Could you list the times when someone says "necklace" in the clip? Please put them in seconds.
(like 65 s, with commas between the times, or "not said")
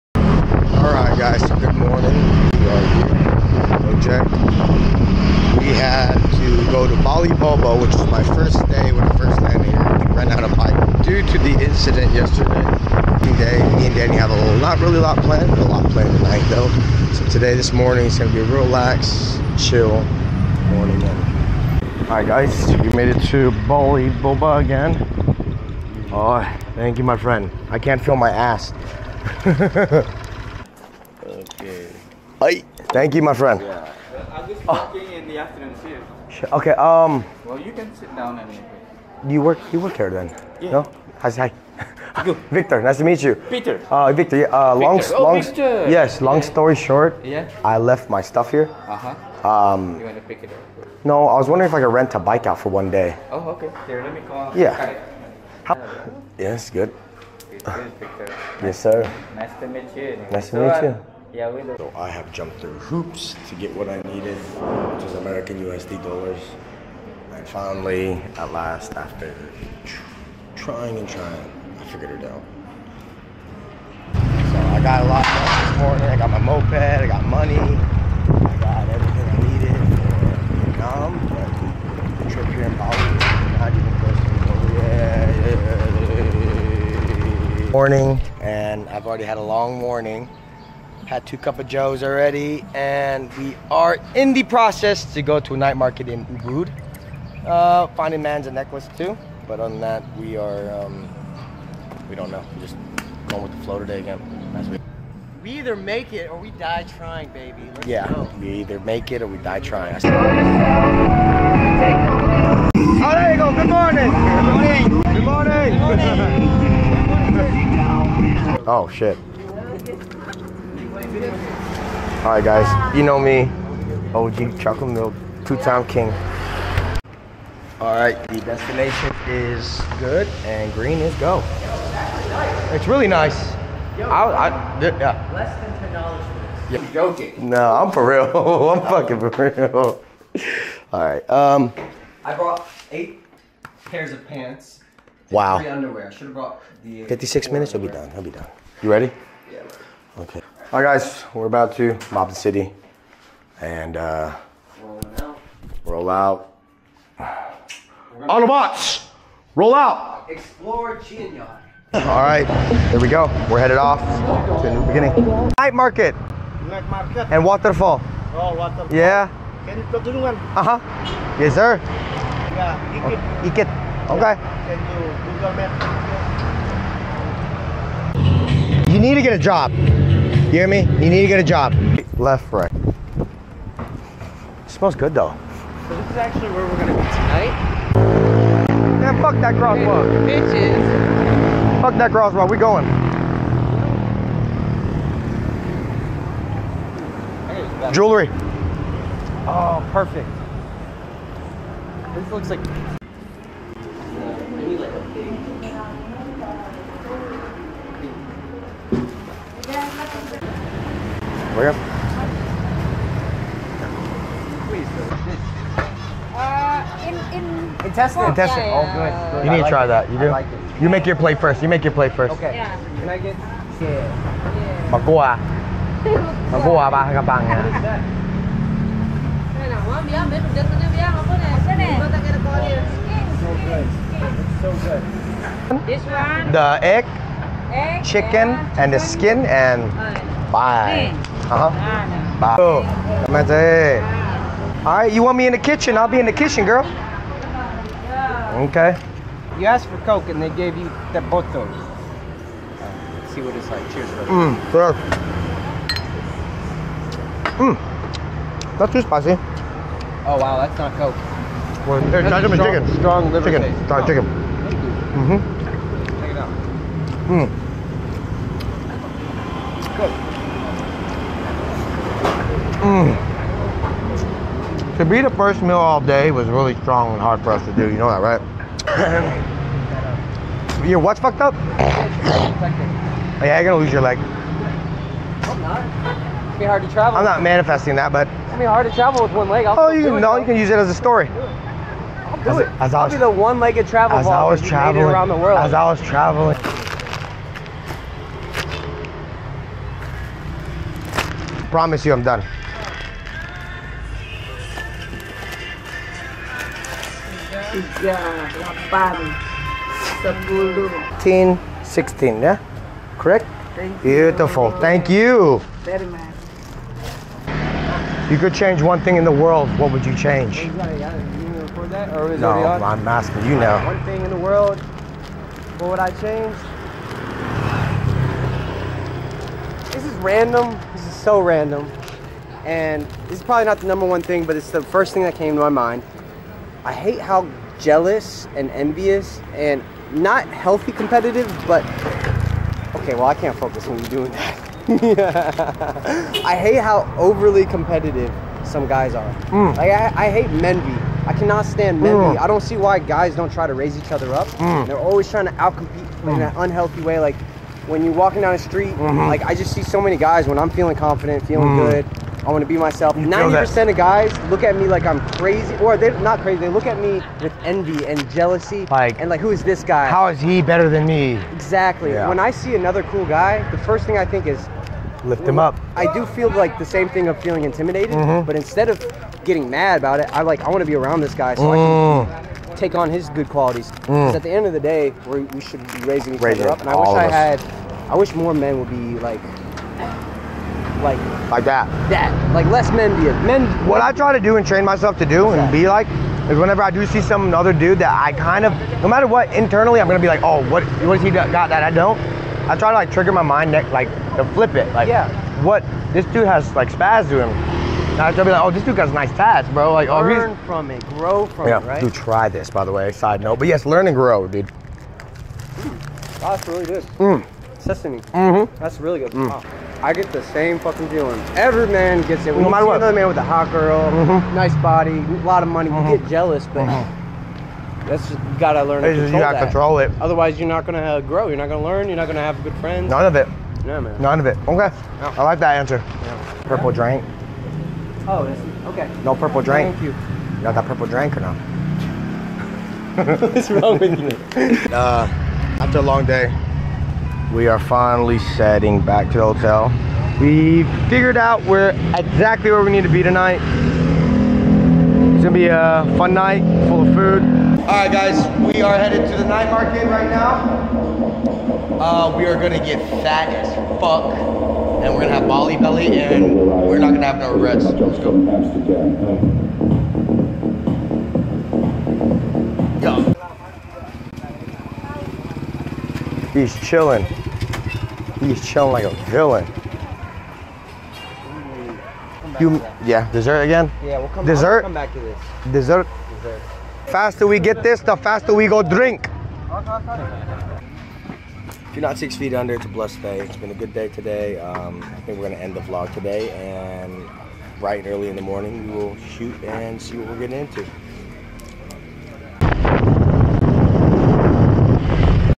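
98 s.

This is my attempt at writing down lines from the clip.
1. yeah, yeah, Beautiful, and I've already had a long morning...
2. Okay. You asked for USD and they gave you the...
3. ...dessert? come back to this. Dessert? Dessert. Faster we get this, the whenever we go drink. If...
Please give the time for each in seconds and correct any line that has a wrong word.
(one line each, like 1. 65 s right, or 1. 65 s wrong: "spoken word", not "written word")
1. 84 s wrong: "Morning", not "Beautiful"
2. 248 s wrong: "Coke", not "USD"
3. 484 s wrong: "faster", not "whenever".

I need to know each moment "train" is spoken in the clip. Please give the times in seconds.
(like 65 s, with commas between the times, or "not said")
394 s.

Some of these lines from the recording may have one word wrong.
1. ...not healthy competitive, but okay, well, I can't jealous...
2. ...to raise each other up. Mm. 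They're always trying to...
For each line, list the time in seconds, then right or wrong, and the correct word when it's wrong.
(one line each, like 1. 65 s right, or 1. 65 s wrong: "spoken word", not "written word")
1. 340 s wrong: "focus", not "jealous"
2. 353 s right.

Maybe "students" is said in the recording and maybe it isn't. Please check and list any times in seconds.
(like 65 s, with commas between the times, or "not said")
not said.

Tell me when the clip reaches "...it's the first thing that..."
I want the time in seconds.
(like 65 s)
334 s.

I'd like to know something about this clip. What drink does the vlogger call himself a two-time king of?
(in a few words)
Chocolate milk.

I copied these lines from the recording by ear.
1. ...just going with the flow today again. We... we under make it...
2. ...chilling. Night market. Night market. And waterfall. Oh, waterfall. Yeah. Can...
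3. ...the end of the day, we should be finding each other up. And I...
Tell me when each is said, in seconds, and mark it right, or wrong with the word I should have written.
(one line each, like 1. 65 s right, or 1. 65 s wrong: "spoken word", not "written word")
1. 102 s wrong: "either", not "under"
2. 164 s wrong: "beginning", not "chilling"
3. 384 s wrong: "raising", not "finding".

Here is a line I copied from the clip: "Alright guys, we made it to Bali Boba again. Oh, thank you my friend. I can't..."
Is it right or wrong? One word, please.
right.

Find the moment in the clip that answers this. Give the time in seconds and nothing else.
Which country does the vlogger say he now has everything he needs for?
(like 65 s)
80 s.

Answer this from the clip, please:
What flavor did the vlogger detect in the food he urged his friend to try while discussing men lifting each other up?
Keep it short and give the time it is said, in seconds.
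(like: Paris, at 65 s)
Sesame, at 417 s.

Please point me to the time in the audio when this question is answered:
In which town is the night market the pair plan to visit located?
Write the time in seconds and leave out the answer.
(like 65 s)
96 s.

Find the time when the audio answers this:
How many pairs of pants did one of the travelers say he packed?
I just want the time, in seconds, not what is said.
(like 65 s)
142 s.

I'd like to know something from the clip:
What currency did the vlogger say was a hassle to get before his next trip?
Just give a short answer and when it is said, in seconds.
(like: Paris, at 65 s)
American USD dollars, at 65 s.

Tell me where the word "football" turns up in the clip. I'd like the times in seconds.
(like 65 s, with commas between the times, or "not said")
not said.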